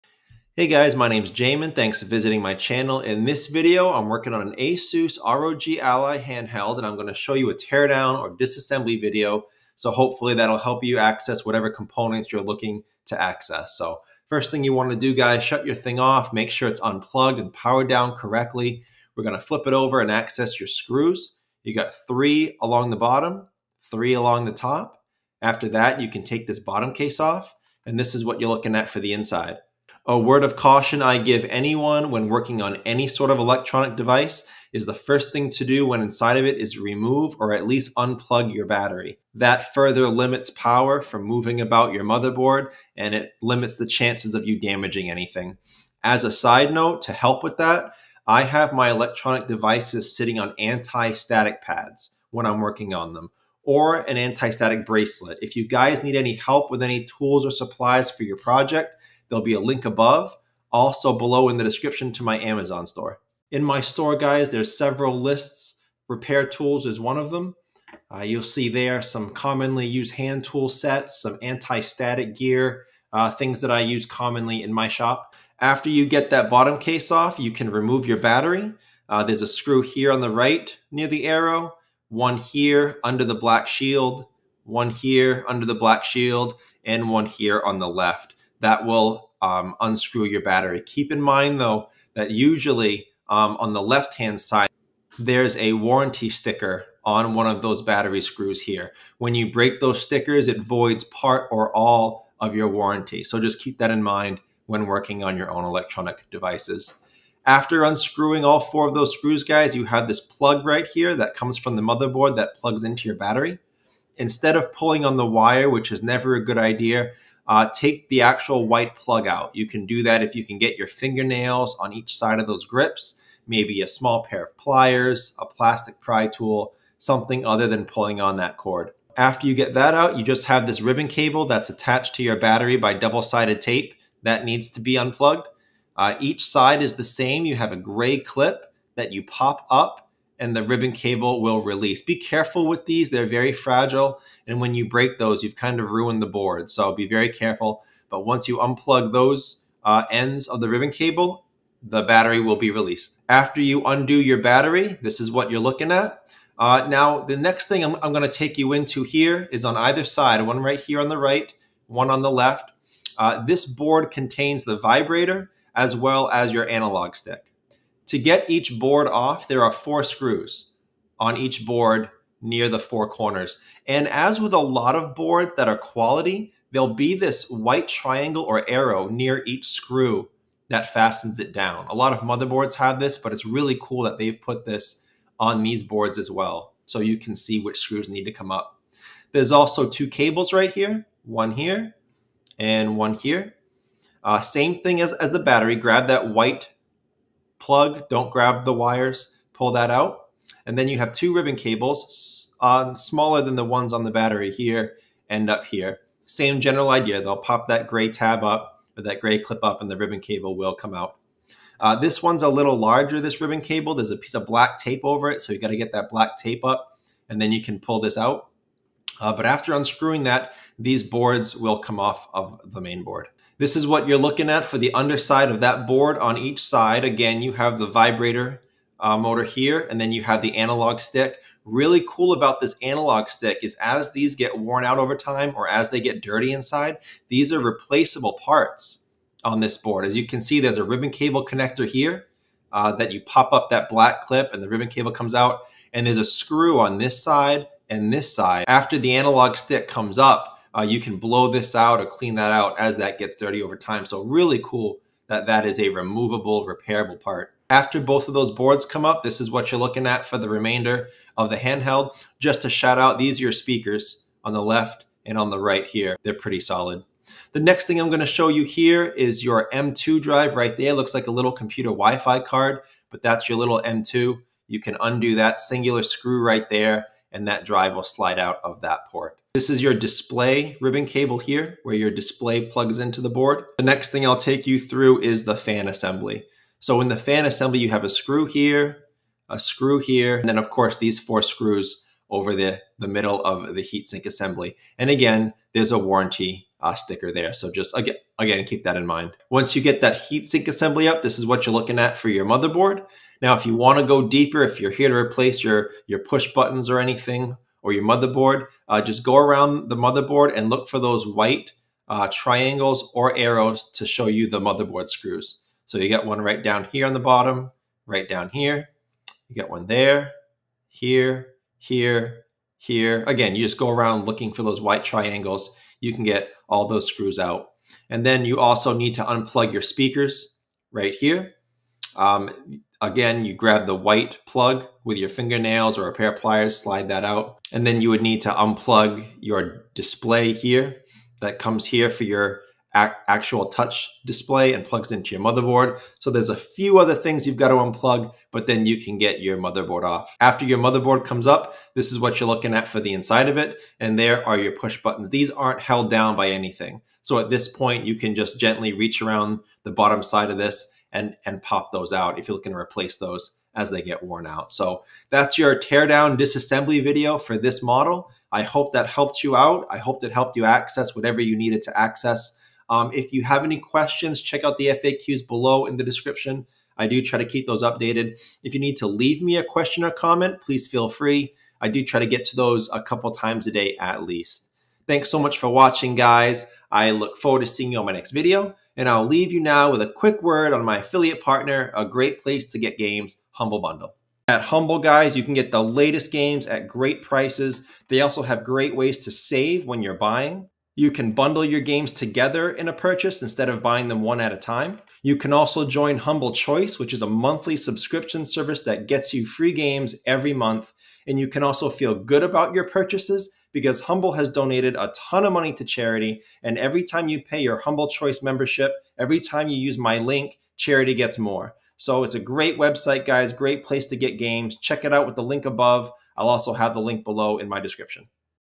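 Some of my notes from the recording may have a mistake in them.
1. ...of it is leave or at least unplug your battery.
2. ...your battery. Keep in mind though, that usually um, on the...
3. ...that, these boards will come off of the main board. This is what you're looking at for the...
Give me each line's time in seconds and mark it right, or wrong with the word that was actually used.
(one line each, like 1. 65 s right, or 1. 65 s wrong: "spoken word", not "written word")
1. 36 s wrong: "remove", not "leave"
2. 90 s right
3. 220 s right.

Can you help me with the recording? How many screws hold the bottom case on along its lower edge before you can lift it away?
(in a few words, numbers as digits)
3.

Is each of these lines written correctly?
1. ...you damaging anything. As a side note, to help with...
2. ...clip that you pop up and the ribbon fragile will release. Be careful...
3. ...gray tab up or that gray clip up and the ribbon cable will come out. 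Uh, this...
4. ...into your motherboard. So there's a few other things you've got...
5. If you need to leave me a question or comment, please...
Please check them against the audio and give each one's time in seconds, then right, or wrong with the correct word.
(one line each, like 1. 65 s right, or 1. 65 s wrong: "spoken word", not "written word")
1. 44 s right
2. 138 s wrong: "cable", not "fragile"
3. 207 s right
4. 345 s right
5. 378 s right.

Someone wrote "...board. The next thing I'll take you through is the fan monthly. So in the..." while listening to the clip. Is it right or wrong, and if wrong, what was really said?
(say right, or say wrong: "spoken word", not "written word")
wrong: "assembly", not "monthly".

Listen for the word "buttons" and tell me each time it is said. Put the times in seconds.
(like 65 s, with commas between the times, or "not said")
306 s, 355 s.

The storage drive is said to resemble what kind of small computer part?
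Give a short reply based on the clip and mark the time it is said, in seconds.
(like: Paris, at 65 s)
Wi-Fi card, at 271 s.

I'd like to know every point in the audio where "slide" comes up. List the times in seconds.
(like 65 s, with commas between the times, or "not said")
278 s, 336 s.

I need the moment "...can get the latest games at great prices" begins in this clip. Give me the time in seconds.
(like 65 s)
395 s.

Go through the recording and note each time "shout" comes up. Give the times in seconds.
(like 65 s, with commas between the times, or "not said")
262 s.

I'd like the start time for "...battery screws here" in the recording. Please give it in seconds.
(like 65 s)
97 s.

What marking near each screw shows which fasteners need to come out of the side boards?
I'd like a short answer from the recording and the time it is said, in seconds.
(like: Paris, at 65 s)
White triangle or arrow, at 177 s.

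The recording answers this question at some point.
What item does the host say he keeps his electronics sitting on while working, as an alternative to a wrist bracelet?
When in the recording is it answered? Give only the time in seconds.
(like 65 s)
50 s.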